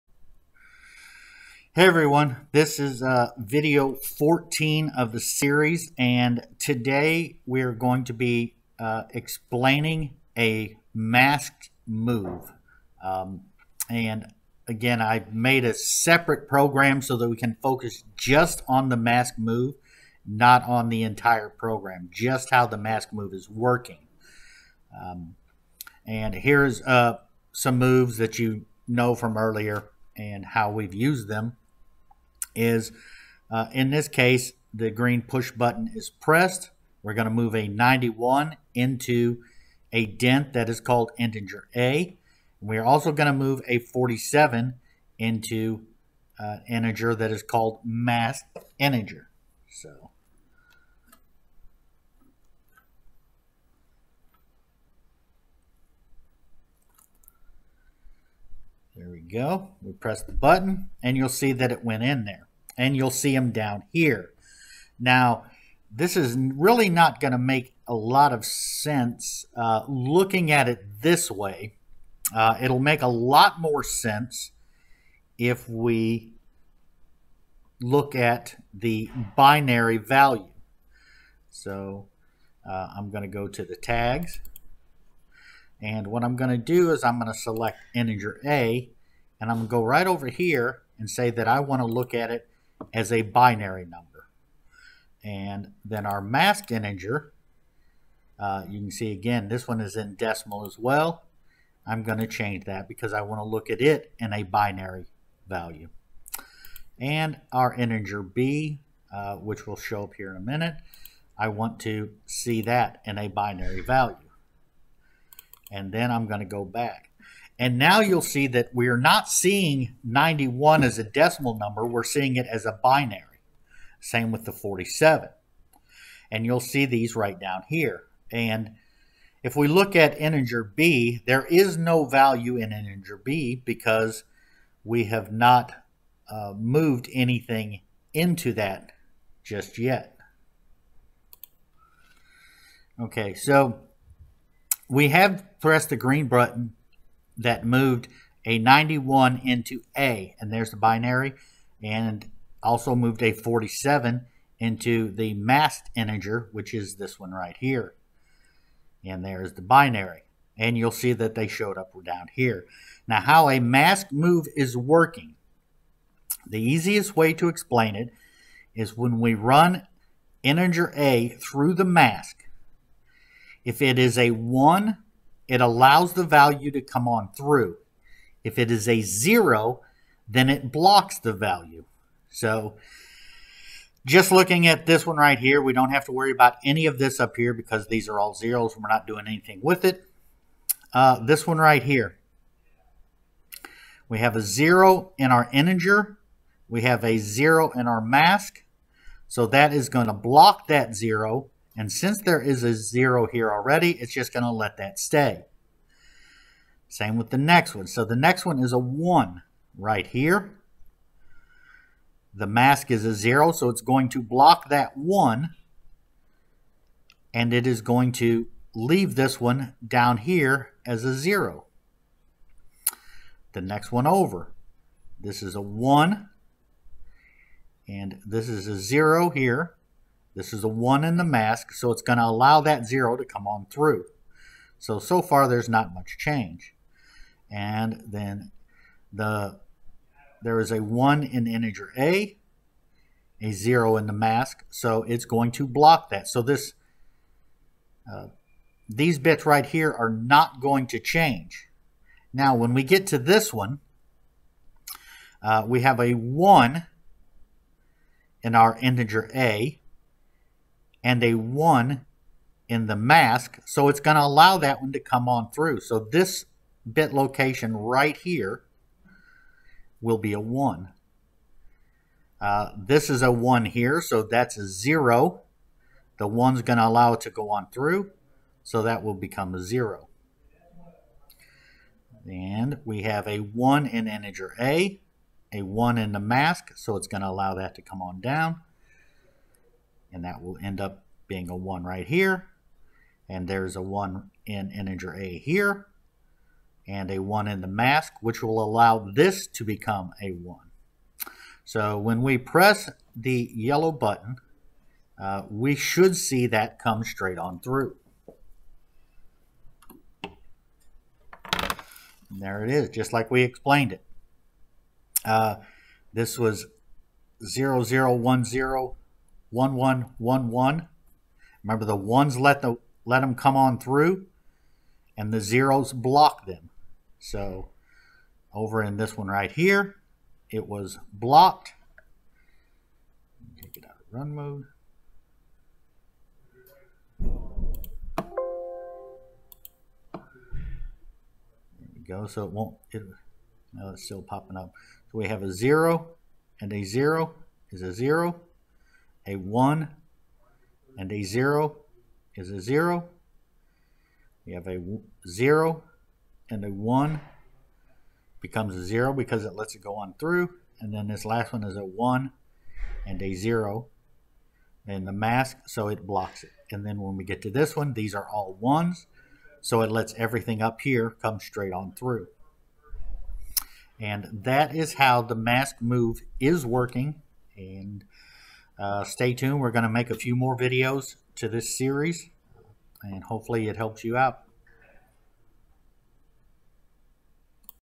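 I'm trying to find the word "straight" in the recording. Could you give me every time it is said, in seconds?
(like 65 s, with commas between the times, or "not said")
307 s, 371 s.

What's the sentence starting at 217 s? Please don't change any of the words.
And it is going to leave this one down here as a 0.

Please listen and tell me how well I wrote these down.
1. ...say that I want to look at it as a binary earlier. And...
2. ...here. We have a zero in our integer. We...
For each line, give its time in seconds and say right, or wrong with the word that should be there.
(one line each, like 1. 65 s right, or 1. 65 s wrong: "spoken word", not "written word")
1. 91 s wrong: "number", not "earlier"
2. 191 s right.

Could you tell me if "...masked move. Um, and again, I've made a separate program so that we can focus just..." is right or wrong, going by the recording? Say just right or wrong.
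right.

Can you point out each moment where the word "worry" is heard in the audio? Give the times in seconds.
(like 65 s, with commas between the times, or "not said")
186 s.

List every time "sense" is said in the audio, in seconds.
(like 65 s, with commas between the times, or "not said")
68 s, 73 s.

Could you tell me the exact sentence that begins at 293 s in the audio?
And there's a 1 in integer a here, and a 1 in the mask, which will allow this to become a 1.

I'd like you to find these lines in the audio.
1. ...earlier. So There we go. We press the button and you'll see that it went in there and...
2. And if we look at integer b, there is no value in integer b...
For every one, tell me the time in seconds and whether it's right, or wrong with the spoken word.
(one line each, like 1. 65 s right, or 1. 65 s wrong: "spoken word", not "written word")
1. 48 s wrong: "integer", not "earlier"
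2. 128 s right.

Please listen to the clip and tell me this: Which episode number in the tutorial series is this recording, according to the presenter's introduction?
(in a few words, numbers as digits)
14.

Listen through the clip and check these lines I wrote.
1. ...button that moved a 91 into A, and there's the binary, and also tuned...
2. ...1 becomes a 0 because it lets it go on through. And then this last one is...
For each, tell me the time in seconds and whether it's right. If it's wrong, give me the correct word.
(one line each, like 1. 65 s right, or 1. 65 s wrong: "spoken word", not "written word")
1. 146 s wrong: "moved", not "tuned"
2. 356 s right.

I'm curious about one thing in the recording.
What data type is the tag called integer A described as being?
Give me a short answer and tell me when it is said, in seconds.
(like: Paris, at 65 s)
DINT, at 40 s.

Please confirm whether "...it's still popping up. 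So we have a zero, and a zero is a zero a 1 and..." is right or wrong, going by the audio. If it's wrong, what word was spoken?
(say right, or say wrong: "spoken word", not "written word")
right.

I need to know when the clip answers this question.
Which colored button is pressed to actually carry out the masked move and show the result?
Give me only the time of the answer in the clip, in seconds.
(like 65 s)
303 s.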